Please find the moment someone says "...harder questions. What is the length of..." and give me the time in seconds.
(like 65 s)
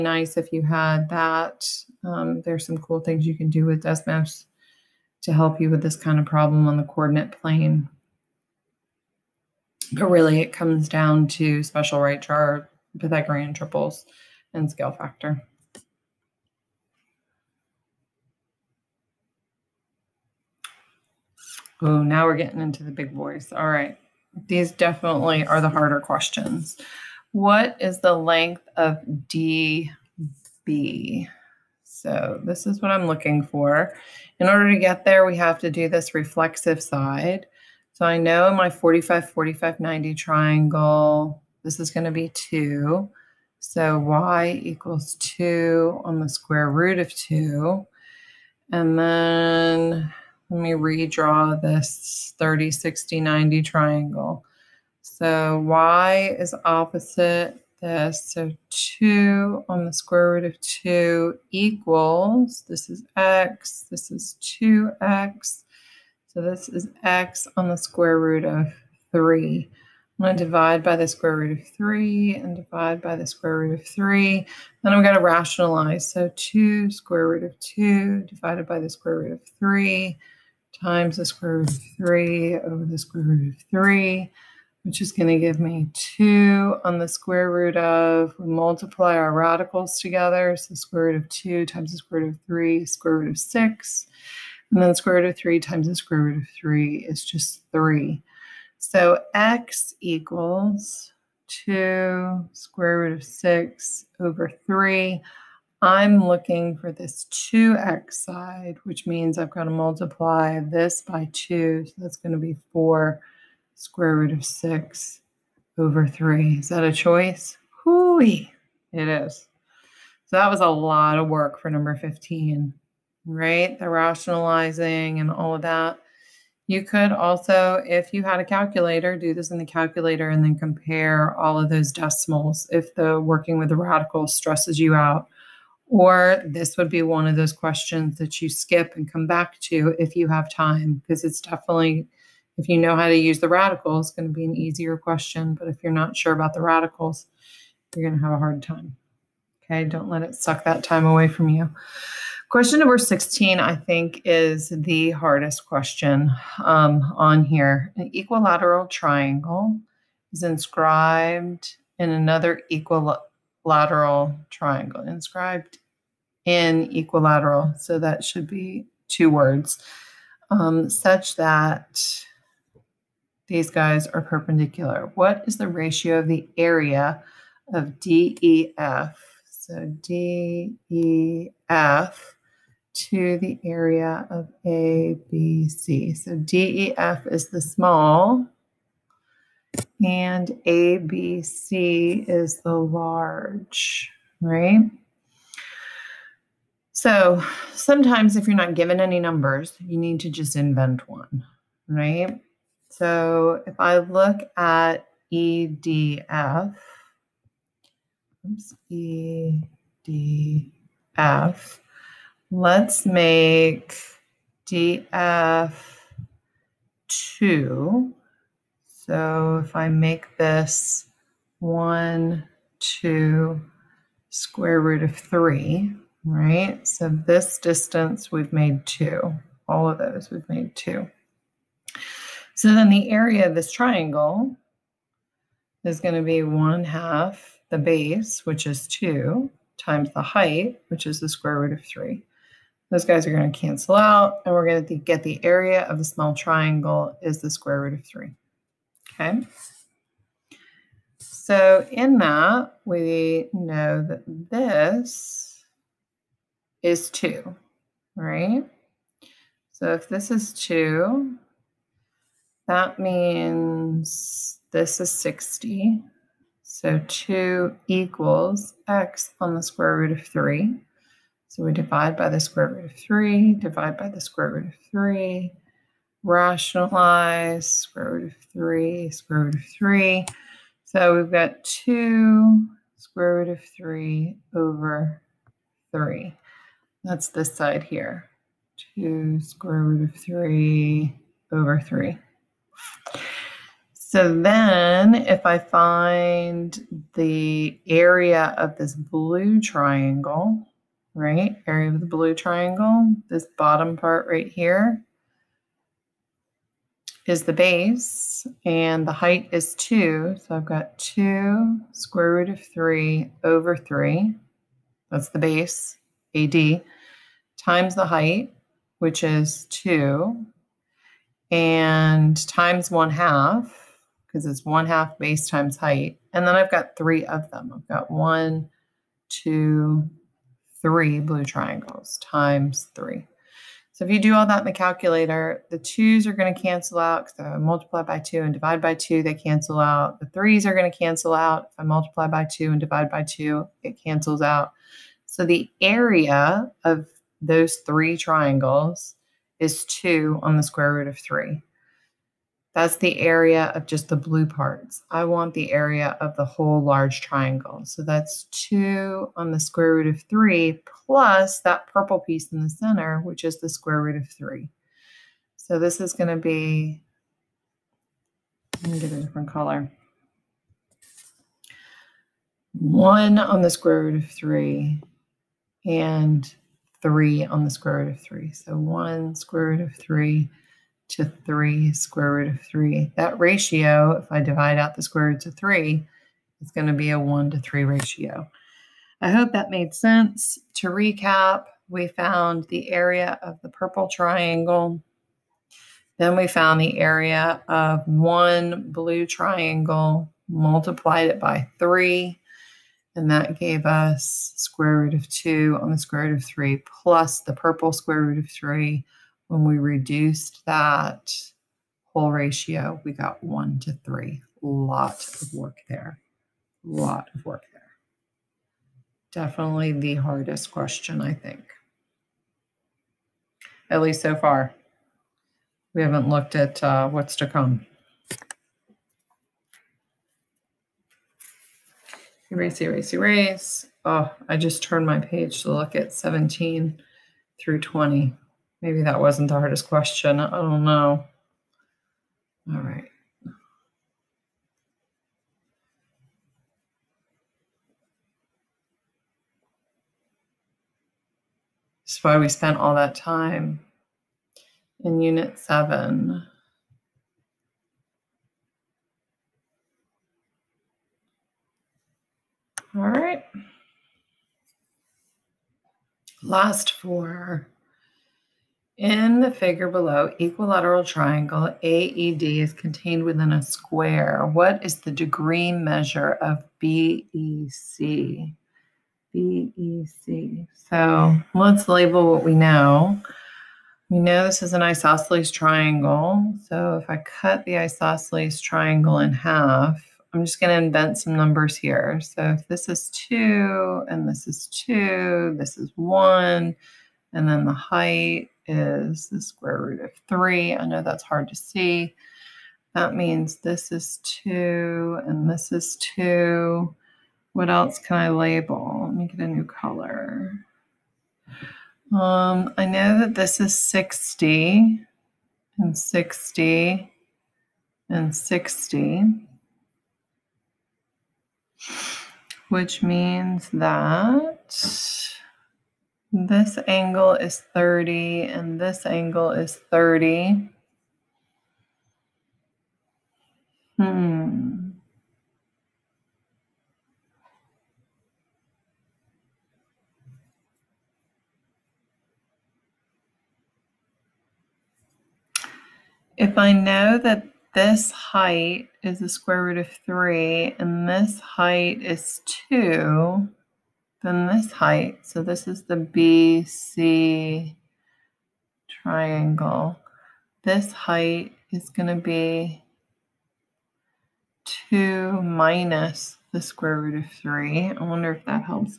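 25 s.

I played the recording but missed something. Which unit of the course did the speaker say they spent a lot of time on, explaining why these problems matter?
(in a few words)
Unit 7.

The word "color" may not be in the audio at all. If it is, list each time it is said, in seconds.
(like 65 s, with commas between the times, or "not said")
369 s, 509 s.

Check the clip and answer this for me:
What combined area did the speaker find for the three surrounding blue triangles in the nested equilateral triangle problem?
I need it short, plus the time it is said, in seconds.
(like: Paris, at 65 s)
2/√3, at 349 s.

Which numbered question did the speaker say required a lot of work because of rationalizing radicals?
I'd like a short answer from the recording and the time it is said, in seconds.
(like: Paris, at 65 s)
15, at 121 s.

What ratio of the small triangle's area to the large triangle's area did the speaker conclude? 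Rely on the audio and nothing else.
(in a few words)
1 to 3.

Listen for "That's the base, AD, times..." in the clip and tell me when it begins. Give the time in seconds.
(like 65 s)
315 s.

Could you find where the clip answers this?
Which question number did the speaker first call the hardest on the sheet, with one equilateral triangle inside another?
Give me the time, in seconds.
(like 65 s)
152 s.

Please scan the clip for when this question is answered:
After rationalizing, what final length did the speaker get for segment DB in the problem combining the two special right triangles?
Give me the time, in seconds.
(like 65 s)
112 s.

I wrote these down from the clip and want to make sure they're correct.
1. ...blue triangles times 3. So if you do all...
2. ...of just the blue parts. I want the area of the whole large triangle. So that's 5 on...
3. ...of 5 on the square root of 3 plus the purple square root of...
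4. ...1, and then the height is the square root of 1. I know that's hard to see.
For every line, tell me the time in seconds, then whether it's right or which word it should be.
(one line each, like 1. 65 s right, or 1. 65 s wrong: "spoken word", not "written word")
1. 331 s right
2. 353 s wrong: "2", not "5"
3. 405 s wrong: "2", not "5"
4. 495 s wrong: "3", not "1".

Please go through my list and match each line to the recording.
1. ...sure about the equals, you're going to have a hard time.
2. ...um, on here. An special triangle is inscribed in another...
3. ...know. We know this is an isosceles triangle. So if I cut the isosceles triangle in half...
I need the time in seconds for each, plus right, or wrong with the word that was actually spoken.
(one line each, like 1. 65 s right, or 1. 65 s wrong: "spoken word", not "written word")
1. 146 s wrong: "radicals", not "equals"
2. 156 s wrong: "equilateral", not "special"
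3. 482 s right.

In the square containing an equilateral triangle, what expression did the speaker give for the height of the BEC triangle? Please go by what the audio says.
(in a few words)
2 - √3.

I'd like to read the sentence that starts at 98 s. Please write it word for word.
So x equals 2 square root of 6 over 3.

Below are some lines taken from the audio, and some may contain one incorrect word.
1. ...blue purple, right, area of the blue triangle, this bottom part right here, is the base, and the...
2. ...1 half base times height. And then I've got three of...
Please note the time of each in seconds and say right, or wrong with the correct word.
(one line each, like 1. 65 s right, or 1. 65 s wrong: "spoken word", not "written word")
1. 298 s wrong: "triangle", not "purple"
2. 324 s right.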